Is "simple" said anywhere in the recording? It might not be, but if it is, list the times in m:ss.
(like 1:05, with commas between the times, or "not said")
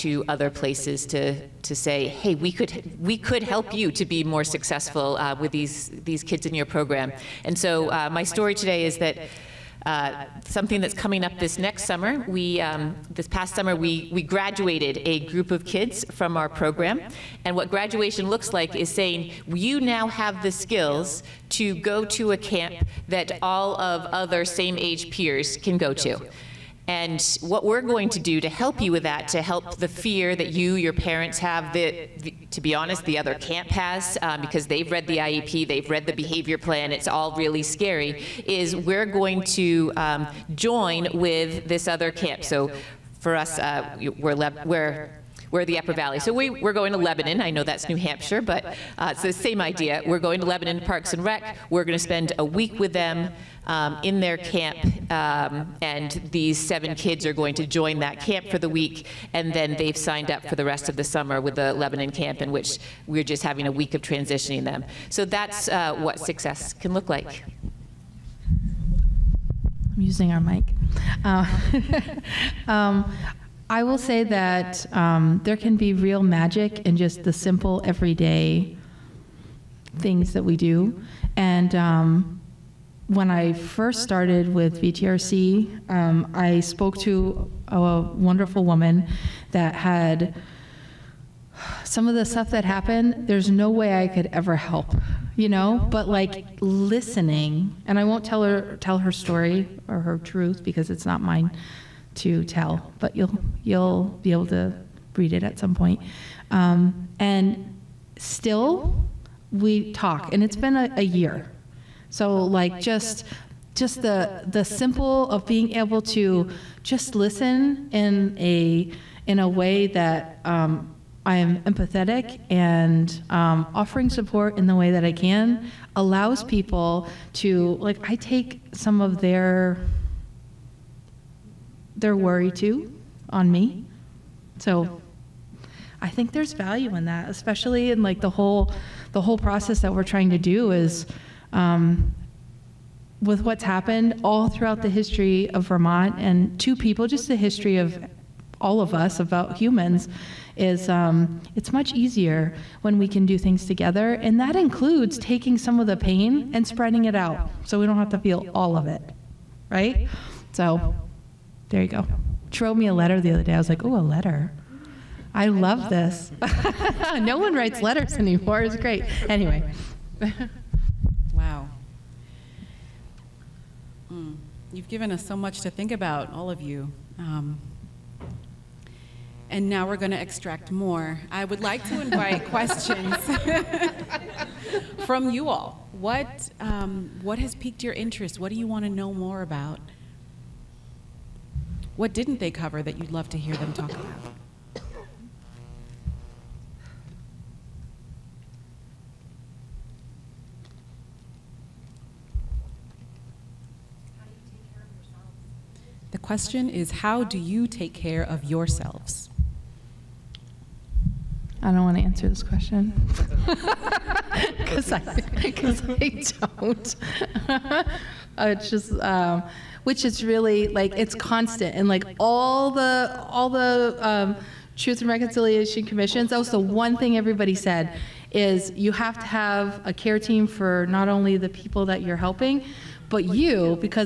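1:17, 1:54.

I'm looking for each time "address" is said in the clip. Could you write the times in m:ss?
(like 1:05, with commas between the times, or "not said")
not said.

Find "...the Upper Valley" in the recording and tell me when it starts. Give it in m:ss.
0:45.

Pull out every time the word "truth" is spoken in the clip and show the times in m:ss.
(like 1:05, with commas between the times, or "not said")
1:40, 3:44.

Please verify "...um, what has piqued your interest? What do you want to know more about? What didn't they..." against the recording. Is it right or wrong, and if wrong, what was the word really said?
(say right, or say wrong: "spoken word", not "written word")
right.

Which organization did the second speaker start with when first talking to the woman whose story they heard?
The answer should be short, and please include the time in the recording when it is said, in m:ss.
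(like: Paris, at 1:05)
VTRC, at 1:24.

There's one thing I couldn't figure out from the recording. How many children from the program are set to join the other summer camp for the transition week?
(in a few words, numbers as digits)
7.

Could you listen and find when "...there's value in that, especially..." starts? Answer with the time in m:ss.
2:16.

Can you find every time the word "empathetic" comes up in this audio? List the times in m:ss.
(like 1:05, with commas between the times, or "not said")
2:01.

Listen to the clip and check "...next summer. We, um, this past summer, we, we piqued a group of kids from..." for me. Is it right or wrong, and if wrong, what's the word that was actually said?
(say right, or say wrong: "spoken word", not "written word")
wrong: "graduated", not "piqued".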